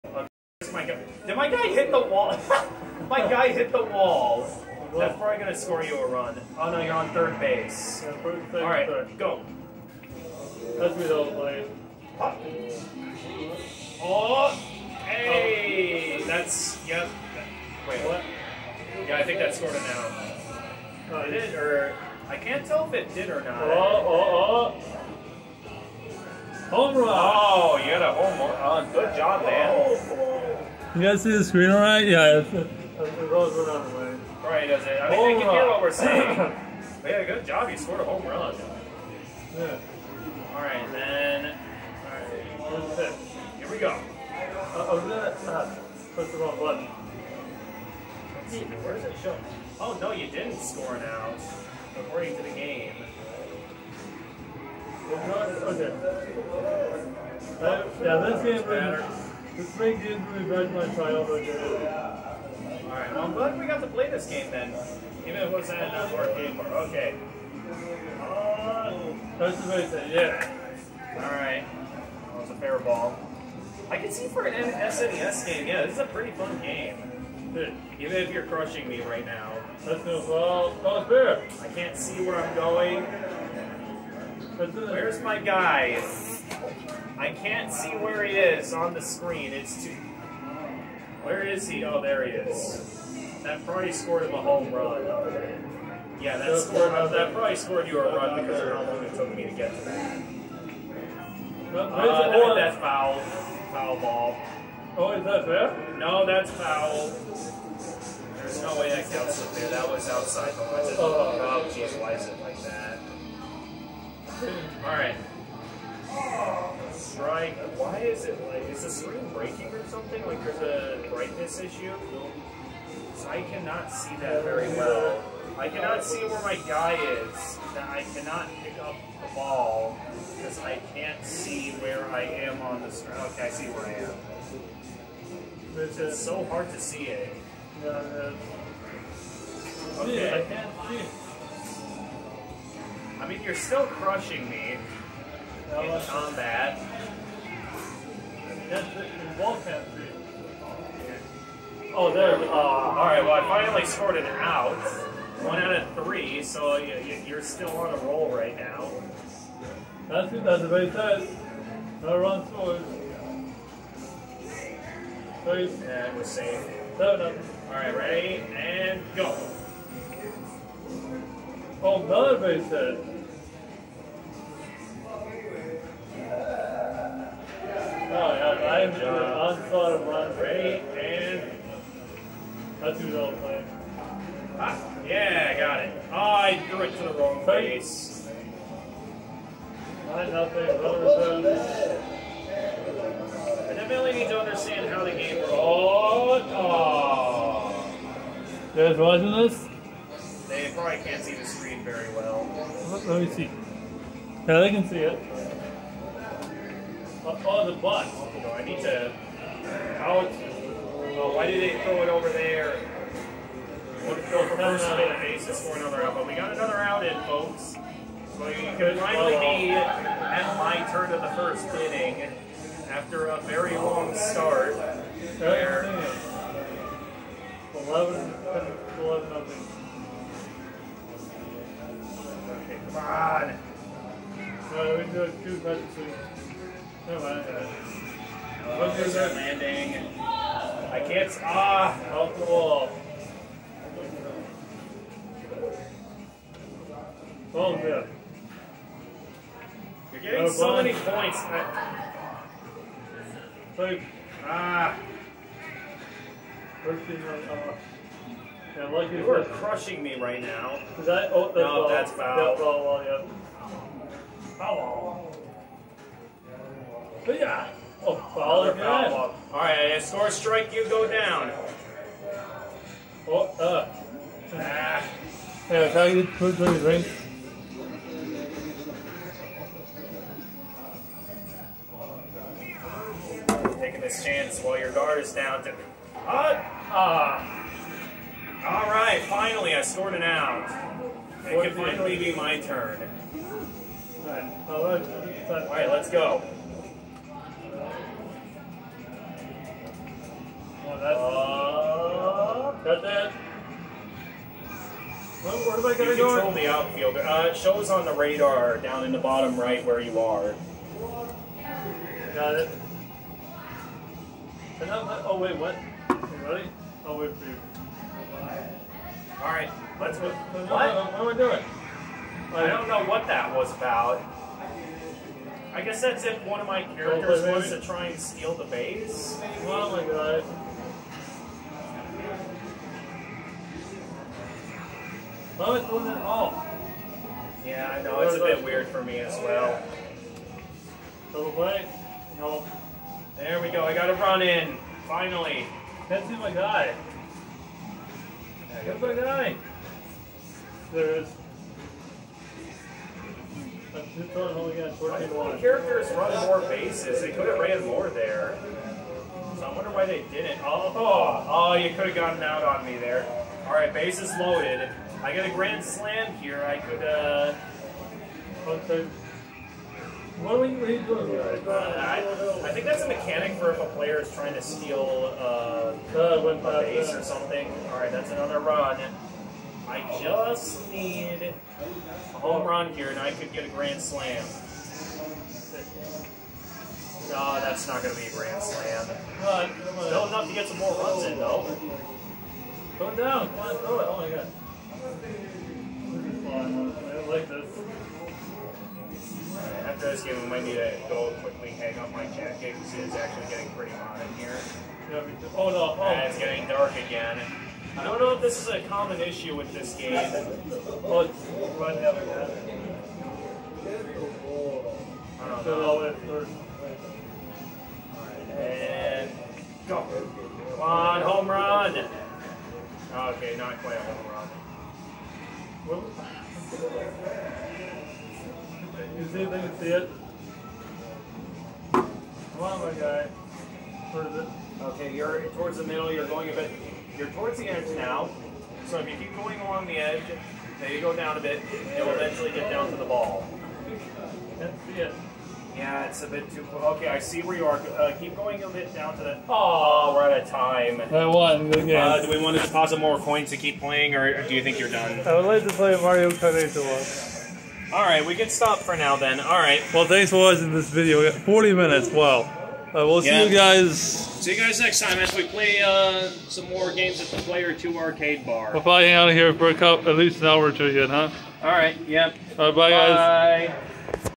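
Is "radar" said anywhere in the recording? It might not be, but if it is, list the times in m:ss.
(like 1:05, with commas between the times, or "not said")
5:08.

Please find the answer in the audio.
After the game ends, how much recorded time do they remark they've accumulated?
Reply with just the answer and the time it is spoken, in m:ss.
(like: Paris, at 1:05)
40 minutes, at 7:41.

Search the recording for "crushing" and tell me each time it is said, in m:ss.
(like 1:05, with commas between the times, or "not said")
1:18, 2:23, 4:19.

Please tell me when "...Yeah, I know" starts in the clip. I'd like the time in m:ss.
5:37.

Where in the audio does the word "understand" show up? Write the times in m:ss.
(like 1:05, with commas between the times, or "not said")
3:14.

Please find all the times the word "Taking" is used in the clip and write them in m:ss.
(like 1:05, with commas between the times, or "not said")
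4:43.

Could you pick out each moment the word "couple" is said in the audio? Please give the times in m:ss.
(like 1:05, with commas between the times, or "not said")
7:49.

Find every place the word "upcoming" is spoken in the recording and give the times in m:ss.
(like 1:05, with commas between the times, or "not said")
not said.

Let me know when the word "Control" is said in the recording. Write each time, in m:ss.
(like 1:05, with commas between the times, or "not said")
5:06.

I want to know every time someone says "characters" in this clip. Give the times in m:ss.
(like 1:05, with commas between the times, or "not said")
5:26, 5:55.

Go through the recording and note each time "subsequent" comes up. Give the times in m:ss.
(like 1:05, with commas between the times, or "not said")
not said.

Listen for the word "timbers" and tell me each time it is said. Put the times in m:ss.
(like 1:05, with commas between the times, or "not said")
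not said.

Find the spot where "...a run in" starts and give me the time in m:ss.
5:44.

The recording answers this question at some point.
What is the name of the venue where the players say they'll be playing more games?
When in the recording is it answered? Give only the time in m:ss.
7:47.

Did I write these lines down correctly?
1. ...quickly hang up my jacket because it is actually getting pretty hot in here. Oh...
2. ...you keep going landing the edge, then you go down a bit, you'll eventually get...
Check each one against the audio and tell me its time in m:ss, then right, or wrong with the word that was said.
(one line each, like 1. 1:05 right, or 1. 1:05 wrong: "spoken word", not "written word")
1. 6:41 right
2. 7:19 wrong: "along", not "landing".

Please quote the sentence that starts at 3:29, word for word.
How well, oh, why do they throw it over there?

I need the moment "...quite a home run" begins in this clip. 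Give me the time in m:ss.
7:03.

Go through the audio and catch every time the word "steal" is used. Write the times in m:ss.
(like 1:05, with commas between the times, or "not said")
5:28, 6:14.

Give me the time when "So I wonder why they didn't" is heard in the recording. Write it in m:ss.
5:59.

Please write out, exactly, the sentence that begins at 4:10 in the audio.
You're getting oh, so many points.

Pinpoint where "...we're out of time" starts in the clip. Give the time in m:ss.
7:30.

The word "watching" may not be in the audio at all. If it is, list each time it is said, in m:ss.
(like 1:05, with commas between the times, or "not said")
3:18, 7:40.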